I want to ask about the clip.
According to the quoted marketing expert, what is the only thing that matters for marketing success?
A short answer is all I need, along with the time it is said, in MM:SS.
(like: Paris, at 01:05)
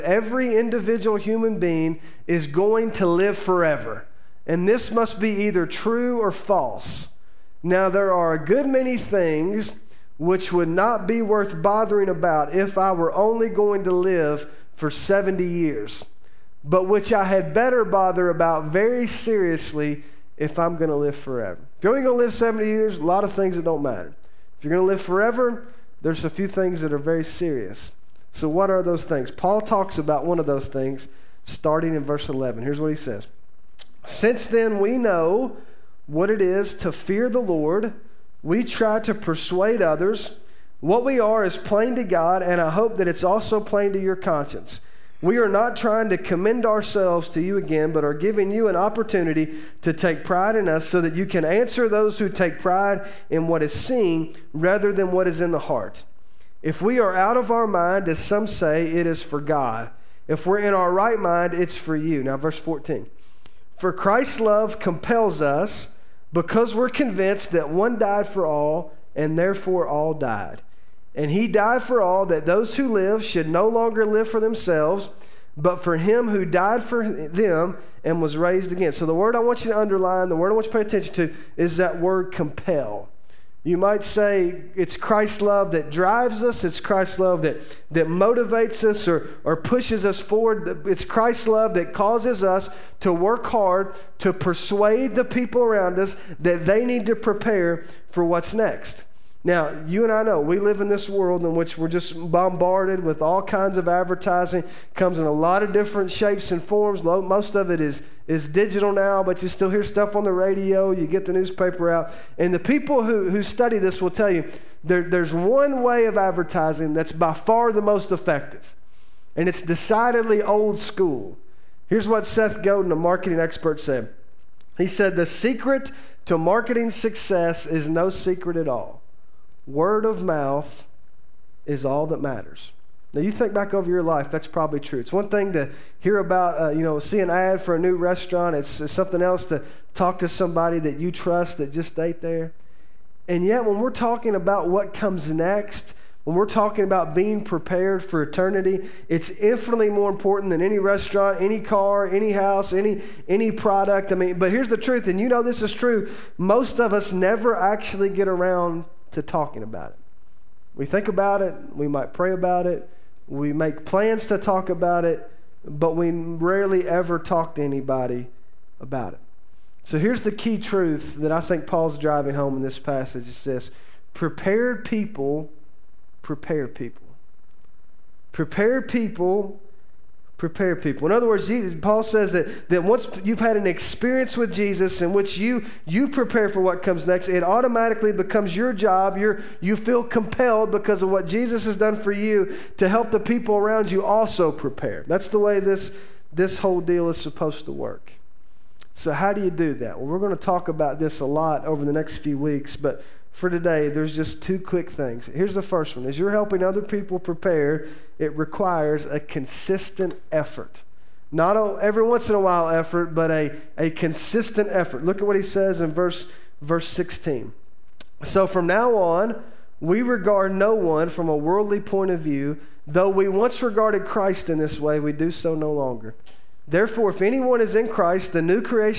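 Word of mouth, at 02:09.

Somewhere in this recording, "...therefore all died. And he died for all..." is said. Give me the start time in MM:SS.
01:09.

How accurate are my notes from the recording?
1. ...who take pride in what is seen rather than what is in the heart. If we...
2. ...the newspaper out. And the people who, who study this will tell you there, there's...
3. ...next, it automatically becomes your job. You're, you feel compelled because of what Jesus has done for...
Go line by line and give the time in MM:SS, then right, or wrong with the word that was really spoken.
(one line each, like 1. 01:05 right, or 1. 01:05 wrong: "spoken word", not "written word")
1. 00:52 right
2. 01:51 right
3. 03:07 right.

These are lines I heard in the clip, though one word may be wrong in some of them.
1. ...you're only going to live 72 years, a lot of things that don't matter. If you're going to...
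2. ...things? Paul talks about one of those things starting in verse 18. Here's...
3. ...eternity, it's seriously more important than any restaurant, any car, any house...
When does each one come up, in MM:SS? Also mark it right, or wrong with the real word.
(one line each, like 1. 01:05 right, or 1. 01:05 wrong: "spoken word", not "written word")
1. 00:21 wrong: "70", not "72"
2. 00:29 wrong: "11", not "18"
3. 02:28 wrong: "infinitely", not "seriously".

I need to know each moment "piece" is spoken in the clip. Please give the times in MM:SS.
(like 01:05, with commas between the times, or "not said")
not said.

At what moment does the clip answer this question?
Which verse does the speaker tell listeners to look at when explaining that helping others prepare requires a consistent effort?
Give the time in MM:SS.
03:36.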